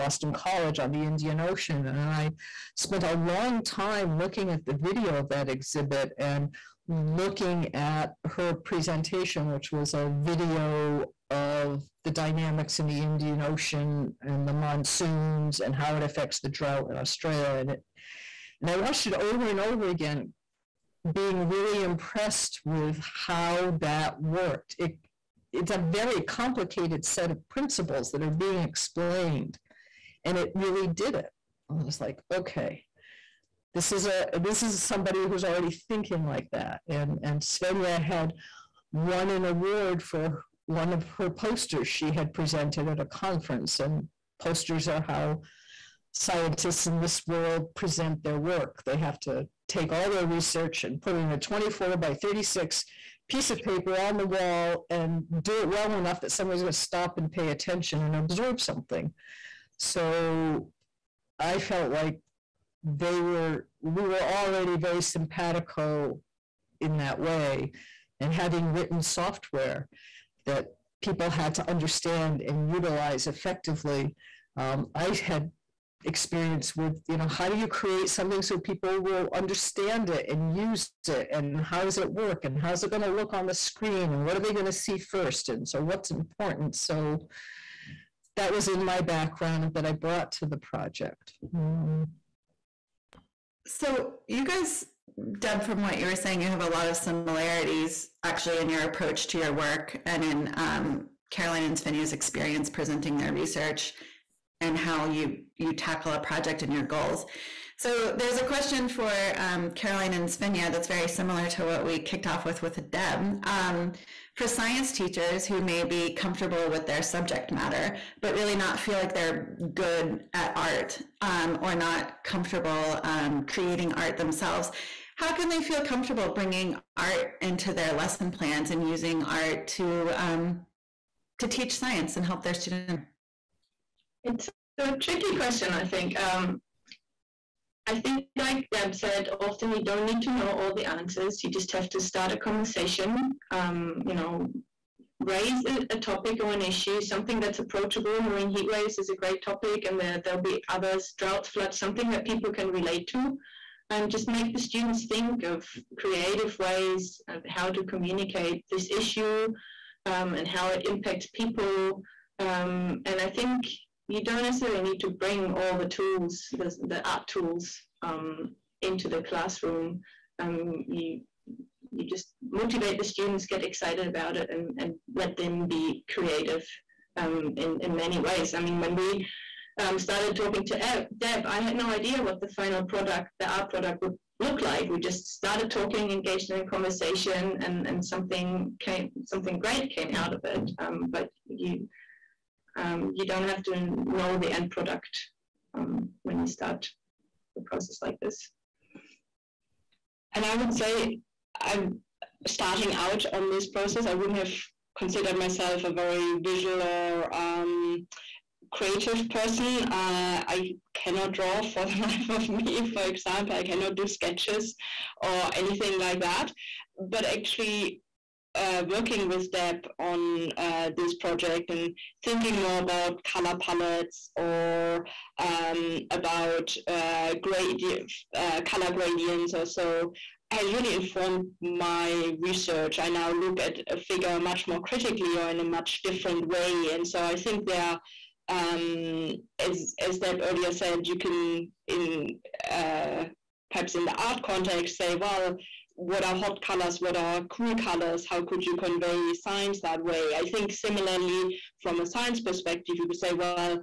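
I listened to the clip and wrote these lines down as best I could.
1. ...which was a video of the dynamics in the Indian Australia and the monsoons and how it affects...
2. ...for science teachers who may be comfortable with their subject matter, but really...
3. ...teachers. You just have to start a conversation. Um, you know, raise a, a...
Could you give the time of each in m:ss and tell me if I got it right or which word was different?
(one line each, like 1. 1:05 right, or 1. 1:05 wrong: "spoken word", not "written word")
1. 0:09 wrong: "Ocean", not "Australia"
2. 1:54 right
3. 2:20 wrong: "answers", not "teachers".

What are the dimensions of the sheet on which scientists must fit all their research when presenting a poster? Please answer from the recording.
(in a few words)
24 by 36.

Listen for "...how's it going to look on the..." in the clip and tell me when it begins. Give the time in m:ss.
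1:22.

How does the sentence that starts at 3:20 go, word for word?
And I would say I'm starting out on this process.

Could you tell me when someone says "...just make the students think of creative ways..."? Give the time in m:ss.
2:34.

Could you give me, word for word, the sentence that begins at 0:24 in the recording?
It, it's a very complicated set of principles that are being explained, and it really did it.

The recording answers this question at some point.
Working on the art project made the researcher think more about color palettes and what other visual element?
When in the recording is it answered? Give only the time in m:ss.
3:48.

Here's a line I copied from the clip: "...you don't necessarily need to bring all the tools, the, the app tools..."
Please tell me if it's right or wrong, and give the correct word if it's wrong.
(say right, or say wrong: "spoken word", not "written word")
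right.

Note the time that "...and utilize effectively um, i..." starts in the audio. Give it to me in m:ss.
1:12.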